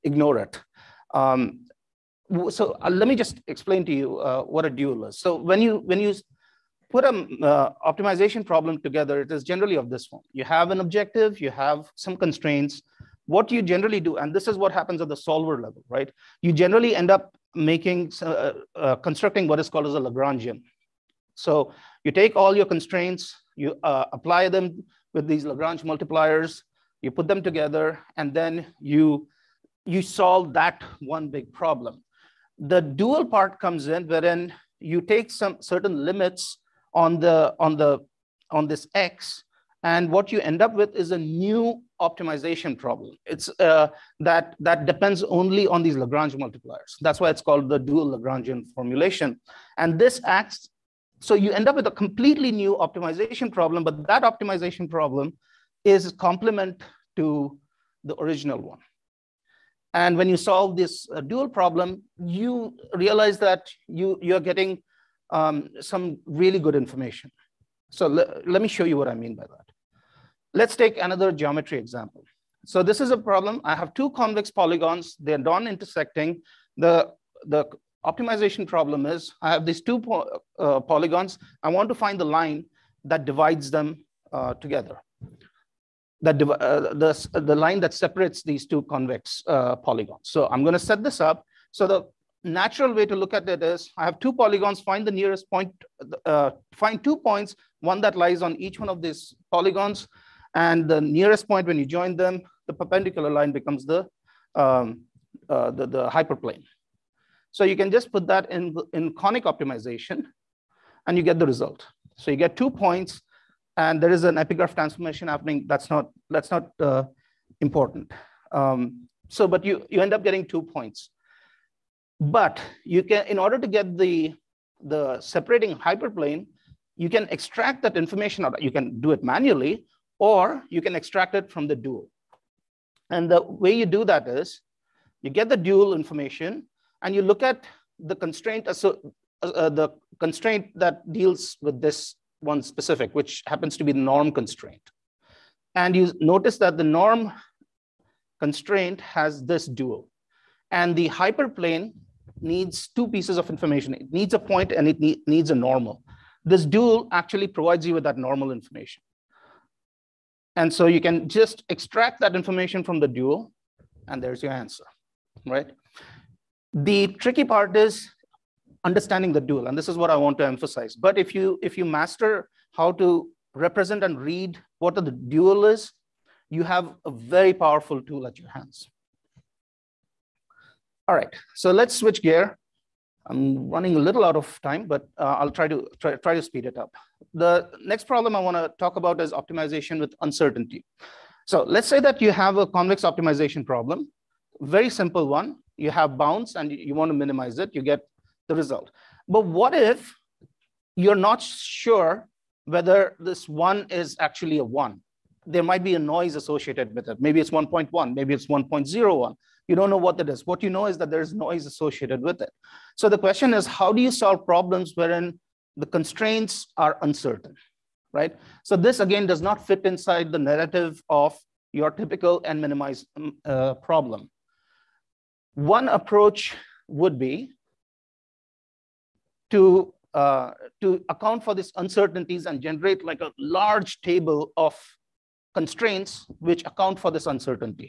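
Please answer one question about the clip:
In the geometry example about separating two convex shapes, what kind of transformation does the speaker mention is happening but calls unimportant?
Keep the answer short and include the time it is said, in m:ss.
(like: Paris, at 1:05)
epigraph transformation, at 1:54.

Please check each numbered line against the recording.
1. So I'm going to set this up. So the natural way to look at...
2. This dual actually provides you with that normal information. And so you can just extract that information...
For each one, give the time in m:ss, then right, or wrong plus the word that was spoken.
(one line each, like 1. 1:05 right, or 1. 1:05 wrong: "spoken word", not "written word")
1. 1:30 right
2. 2:36 right.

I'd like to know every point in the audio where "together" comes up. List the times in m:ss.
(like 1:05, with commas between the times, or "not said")
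0:08, 0:27, 1:24.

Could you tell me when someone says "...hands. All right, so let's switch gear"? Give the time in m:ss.
2:58.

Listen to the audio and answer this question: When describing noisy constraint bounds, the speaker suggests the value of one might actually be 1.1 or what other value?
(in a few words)
1.01.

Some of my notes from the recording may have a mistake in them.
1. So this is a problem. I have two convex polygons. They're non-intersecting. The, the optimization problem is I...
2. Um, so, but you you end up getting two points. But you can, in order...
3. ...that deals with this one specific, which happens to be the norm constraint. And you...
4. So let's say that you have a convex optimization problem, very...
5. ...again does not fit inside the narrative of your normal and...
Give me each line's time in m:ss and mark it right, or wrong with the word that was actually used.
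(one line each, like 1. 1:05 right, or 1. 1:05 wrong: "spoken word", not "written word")
1. 1:12 right
2. 1:58 right
3. 2:20 right
4. 3:11 right
5. 3:38 wrong: "typical", not "normal".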